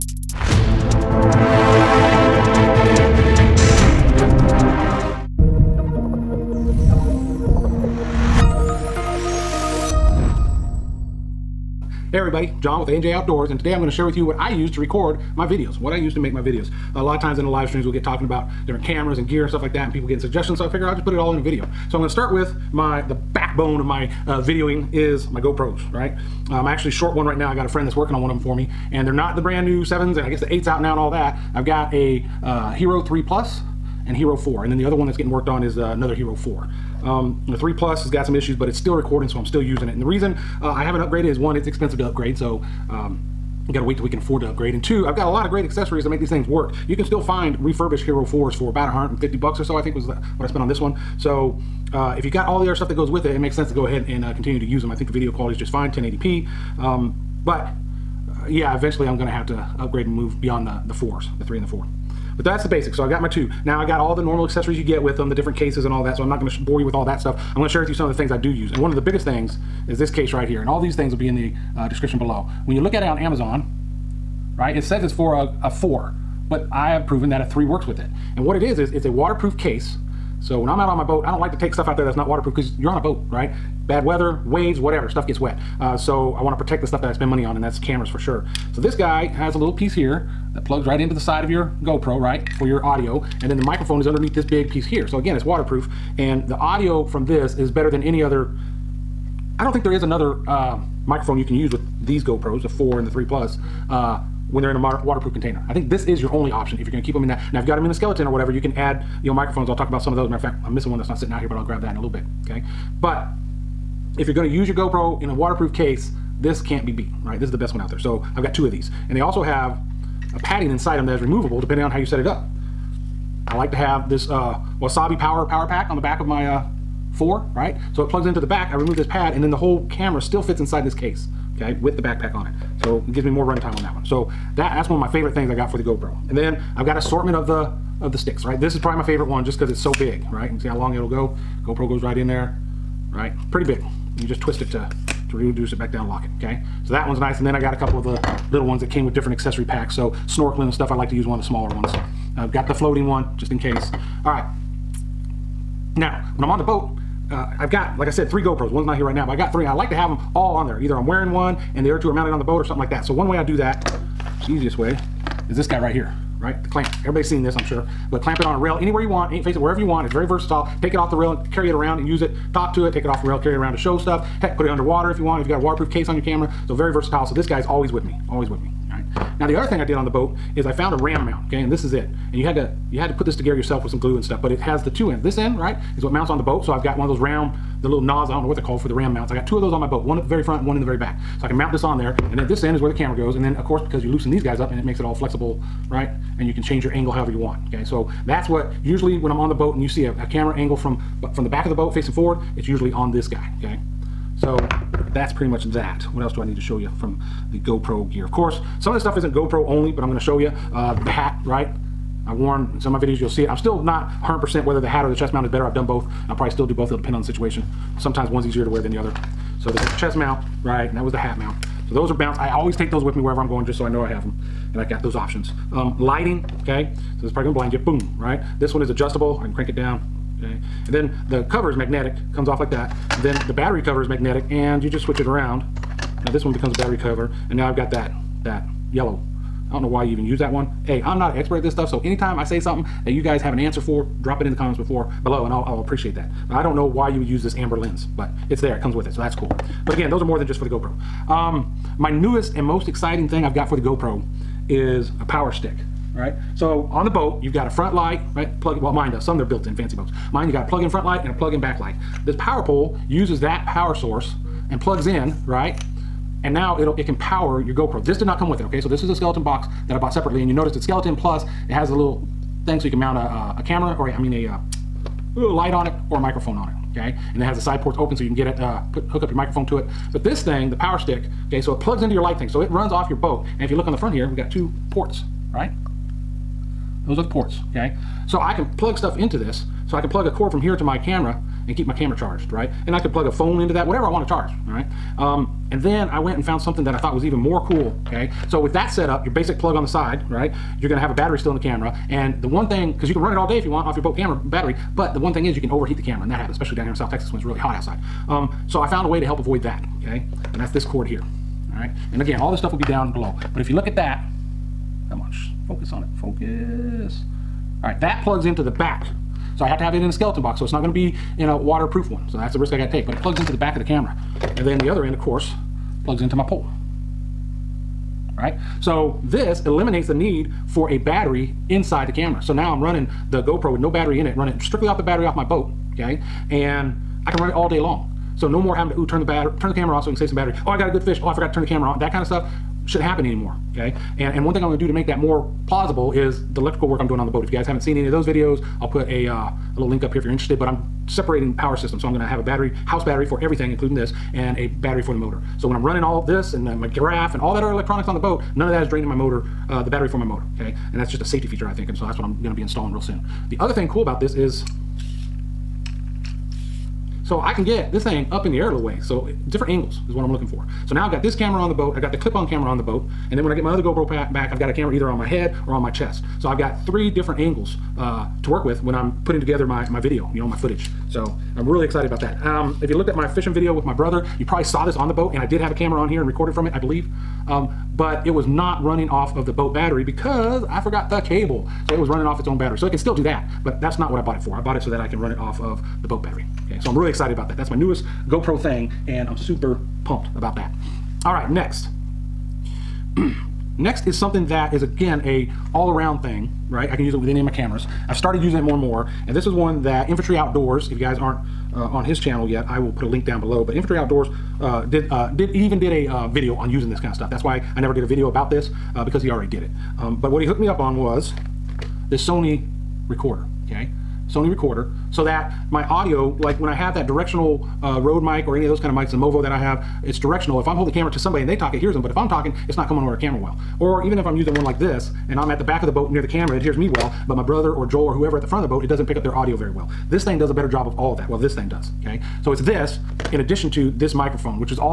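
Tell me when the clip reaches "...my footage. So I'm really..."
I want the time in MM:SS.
06:20.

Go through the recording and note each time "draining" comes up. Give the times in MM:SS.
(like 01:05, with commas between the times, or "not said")
05:58.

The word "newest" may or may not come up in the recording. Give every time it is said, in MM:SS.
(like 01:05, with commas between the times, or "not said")
04:12, 06:37.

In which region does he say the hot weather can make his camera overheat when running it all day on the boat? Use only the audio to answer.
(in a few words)
South Texas.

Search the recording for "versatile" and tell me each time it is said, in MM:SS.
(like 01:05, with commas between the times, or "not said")
02:50, 02:56.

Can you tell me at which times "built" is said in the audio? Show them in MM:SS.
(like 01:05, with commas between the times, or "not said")
04:19.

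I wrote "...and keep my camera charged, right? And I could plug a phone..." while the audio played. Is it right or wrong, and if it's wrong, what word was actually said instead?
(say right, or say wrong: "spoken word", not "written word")
right.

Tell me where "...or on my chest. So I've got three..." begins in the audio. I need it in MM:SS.
06:15.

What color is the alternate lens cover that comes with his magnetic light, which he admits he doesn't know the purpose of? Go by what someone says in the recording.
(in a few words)
Amber.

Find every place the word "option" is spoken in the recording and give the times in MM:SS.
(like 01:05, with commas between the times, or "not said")
01:46, 03:45.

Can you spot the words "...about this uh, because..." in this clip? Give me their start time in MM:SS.
06:58.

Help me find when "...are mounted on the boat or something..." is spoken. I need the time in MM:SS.
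02:42.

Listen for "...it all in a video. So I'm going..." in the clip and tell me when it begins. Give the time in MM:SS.
00:21.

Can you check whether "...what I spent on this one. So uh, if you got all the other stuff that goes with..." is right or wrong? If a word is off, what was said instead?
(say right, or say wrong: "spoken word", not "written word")
right.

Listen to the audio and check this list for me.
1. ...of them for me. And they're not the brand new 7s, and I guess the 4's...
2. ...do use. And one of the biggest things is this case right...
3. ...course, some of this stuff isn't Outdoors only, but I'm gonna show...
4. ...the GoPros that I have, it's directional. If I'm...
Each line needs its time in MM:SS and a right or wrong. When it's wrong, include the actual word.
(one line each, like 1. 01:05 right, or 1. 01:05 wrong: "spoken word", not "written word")
1. 00:28 wrong: "8", not "4"
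2. 01:08 right
3. 03:28 wrong: "GoPro", not "Outdoors"
4. 07:09 wrong: "Movo", not "GoPros".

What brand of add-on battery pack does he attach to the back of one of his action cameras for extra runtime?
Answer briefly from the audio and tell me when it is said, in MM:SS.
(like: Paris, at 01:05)
Wasabi, at 02:04.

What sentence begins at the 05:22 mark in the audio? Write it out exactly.
So that's the risk I gotta take, but it plugs into the back of the camera.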